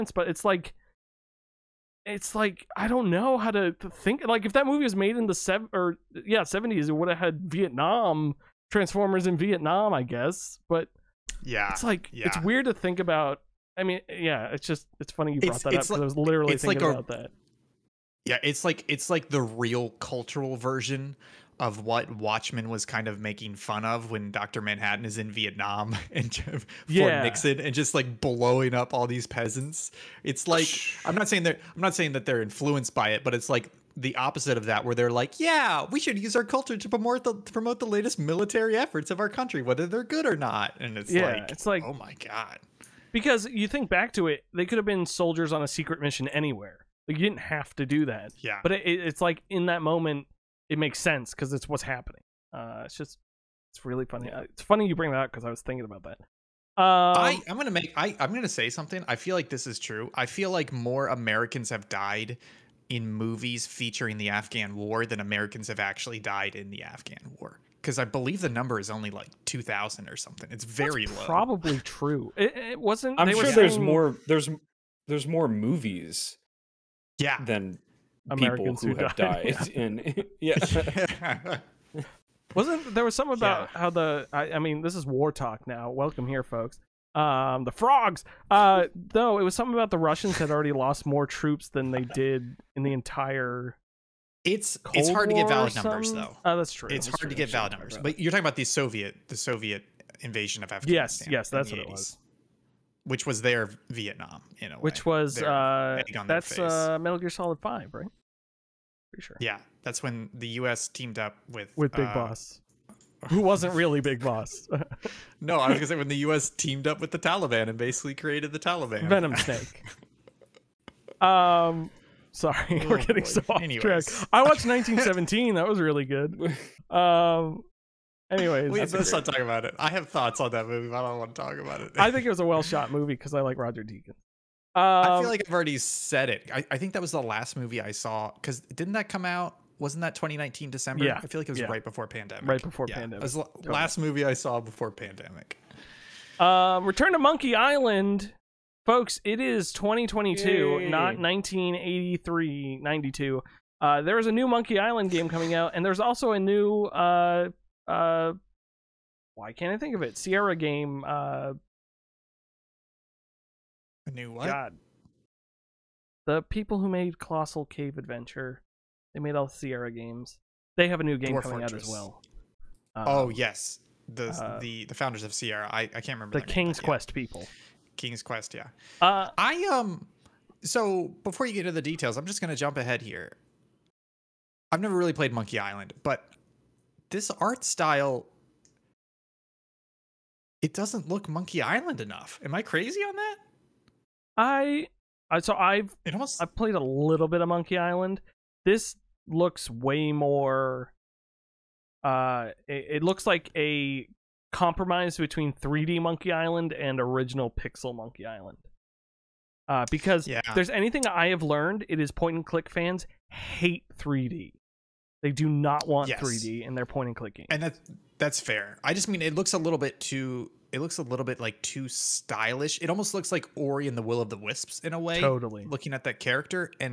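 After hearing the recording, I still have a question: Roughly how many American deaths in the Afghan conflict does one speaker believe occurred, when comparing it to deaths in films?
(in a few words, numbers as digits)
2,000.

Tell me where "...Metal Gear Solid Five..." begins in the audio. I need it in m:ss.
1:46.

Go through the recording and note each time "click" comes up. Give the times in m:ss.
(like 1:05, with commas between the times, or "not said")
3:32, 3:37.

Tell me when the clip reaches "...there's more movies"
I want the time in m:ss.
1:15.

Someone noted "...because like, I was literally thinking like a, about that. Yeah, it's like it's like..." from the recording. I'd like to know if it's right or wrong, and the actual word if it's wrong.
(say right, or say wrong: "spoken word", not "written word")
right.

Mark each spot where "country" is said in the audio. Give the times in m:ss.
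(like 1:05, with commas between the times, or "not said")
0:39.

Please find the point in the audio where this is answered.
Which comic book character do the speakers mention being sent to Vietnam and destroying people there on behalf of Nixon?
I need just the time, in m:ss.
0:24.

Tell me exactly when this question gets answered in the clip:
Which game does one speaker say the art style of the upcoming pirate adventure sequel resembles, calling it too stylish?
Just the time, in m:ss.
3:43.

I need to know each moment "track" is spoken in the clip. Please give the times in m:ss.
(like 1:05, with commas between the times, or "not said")
2:04.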